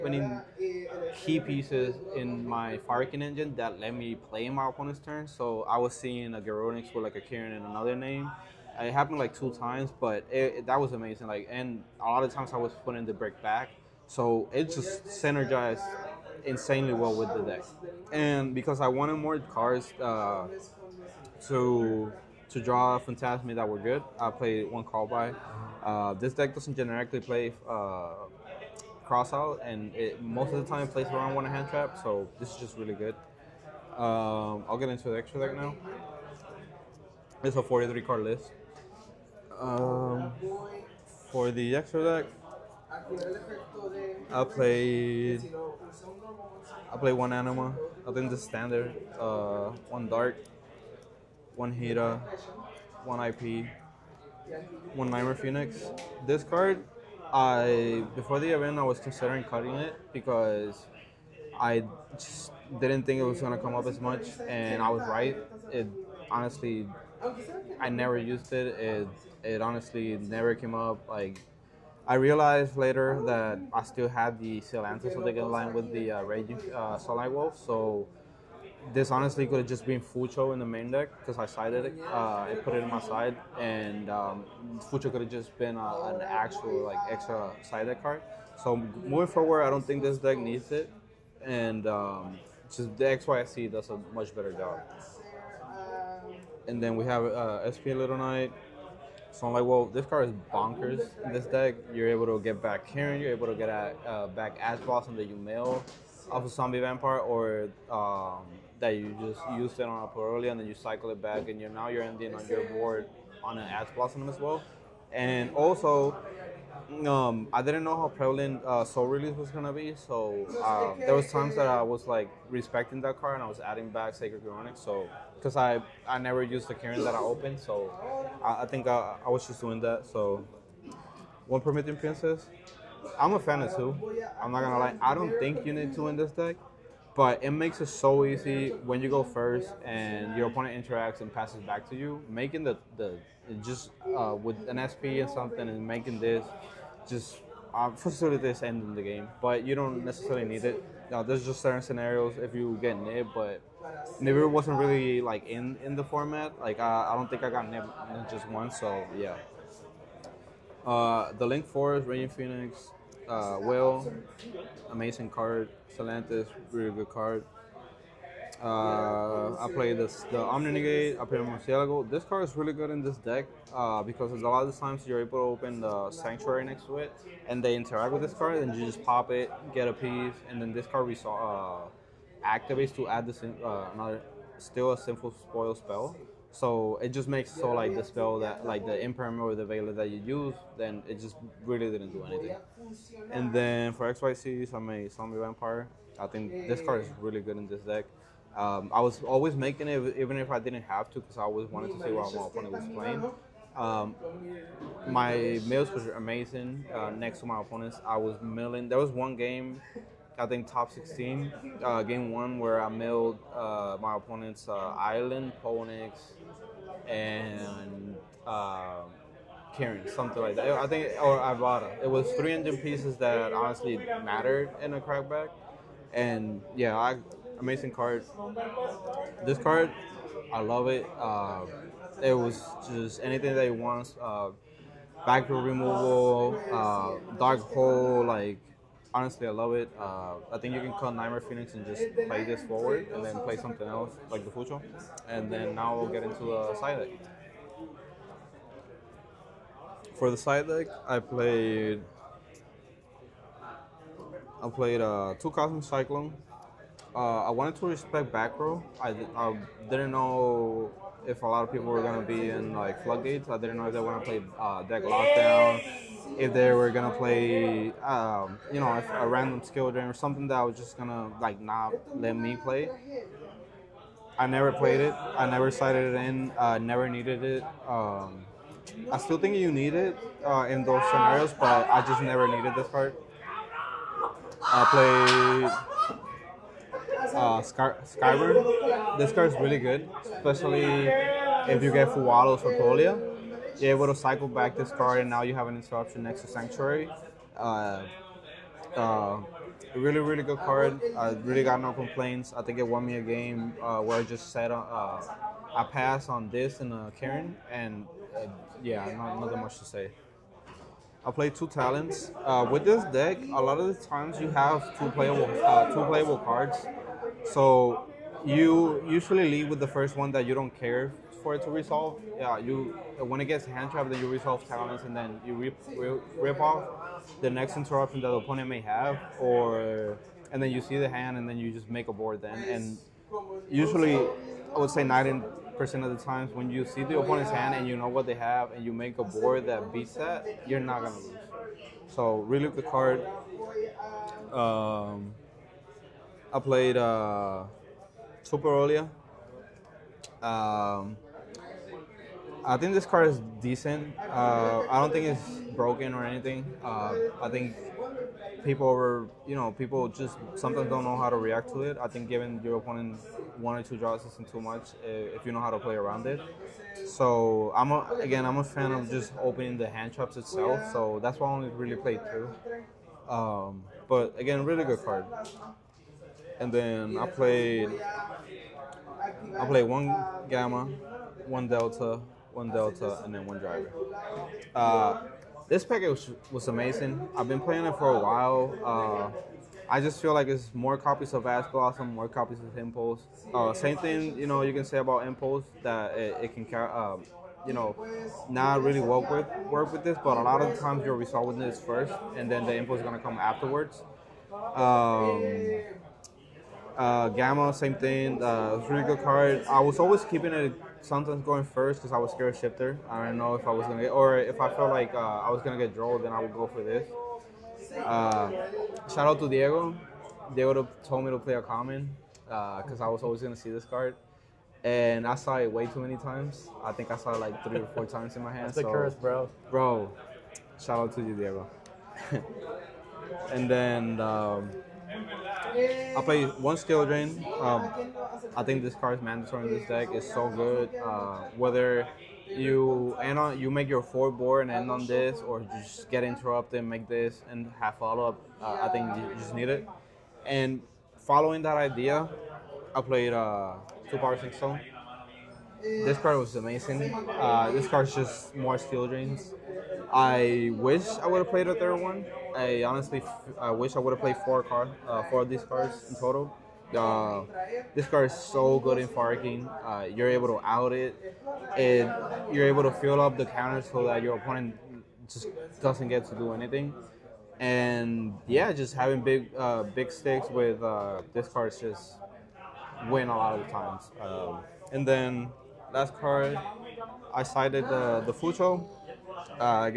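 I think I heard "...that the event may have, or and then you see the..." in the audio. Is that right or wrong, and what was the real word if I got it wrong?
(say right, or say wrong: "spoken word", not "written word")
wrong: "opponent", not "event".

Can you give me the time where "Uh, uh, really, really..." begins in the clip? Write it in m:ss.
4:57.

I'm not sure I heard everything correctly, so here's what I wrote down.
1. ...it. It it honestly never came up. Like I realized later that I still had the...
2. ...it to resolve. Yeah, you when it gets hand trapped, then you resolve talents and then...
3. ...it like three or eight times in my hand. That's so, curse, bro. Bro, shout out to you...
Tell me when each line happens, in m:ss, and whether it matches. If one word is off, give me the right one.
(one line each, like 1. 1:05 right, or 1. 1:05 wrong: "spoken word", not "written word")
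1. 1:08 right
2. 5:21 right
3. 7:07 wrong: "four", not "eight".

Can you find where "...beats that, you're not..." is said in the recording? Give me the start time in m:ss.
5:39.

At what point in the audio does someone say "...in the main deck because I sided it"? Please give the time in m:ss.
1:20.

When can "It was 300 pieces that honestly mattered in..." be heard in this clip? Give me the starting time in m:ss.
3:42.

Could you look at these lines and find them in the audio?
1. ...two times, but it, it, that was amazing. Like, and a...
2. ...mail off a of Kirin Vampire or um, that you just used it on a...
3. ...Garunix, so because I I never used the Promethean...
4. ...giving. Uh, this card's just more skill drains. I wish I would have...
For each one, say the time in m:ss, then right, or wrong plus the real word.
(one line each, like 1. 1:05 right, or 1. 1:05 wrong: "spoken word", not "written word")
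1. 0:09 right
2. 1:45 wrong: "Zombie", not "Kirin"
3. 2:04 wrong: "Kirin", not "Promethean"
4. 7:36 wrong: "amazing", not "giving".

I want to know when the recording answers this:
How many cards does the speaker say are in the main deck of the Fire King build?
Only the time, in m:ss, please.
0:37.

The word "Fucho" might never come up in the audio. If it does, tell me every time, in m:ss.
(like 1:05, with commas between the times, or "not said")
1:19, 1:24, 4:04, 8:08.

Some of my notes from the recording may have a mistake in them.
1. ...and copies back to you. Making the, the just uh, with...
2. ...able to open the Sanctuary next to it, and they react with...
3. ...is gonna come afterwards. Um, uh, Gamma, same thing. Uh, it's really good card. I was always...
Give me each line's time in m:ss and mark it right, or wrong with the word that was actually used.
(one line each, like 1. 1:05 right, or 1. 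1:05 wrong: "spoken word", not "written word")
1. 2:21 wrong: "passes", not "copies"
2. 2:55 wrong: "interact", not "react"
3. 6:42 right.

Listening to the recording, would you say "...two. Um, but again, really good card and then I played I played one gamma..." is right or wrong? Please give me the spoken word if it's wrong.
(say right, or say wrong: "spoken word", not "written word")
right.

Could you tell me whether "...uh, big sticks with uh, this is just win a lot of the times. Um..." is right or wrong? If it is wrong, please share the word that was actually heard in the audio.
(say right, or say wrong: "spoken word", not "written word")
right.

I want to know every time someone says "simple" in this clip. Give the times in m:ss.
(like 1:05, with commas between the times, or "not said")
3:04.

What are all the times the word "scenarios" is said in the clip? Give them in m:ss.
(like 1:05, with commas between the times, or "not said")
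2:31, 4:41.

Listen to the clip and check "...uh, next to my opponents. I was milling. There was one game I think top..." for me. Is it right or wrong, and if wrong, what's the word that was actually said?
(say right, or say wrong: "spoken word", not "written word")
right.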